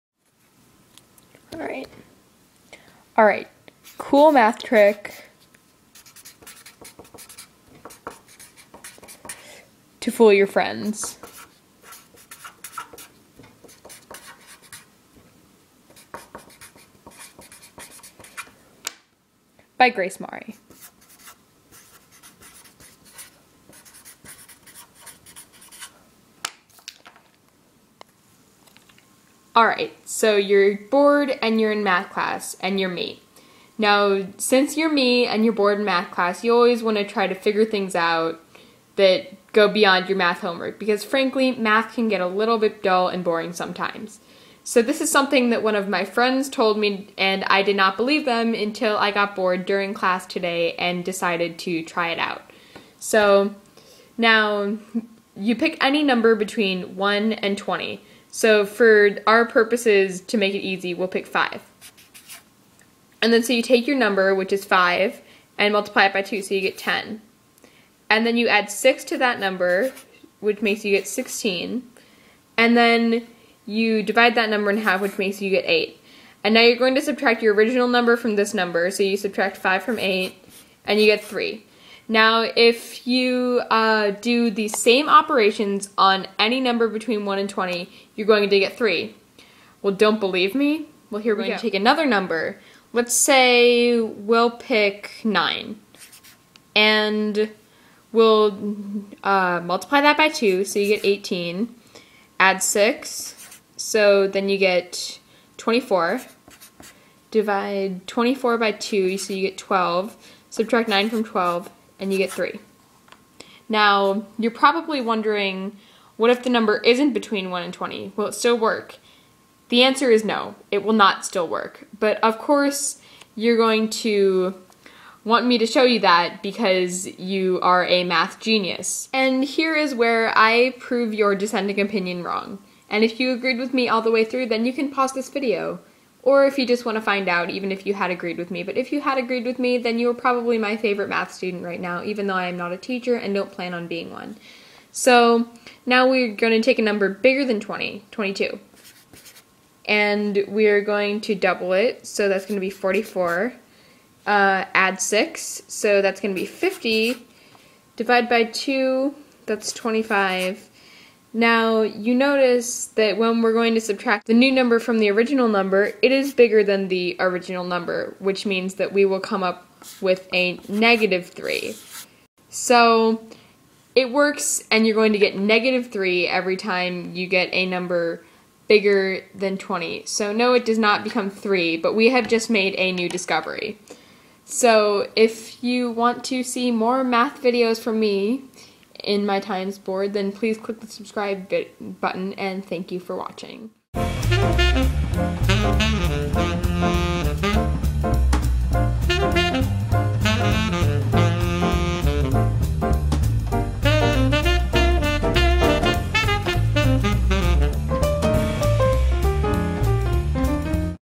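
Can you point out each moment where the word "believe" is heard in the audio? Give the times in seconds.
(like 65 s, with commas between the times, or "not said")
47 s, 90 s.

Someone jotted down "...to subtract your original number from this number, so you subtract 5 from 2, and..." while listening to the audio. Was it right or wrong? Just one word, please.
wrong.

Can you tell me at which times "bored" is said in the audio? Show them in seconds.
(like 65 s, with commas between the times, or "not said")
30 s, 35 s, 49 s.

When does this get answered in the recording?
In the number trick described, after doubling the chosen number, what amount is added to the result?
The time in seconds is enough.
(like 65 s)
68 s.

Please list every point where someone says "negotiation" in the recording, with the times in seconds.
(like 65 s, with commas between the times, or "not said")
not said.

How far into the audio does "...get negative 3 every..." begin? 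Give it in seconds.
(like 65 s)
175 s.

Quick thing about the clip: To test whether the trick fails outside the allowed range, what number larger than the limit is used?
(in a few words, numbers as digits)
22.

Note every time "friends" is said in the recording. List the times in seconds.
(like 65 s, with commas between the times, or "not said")
10 s, 46 s.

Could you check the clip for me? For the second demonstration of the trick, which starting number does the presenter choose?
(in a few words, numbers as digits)
9.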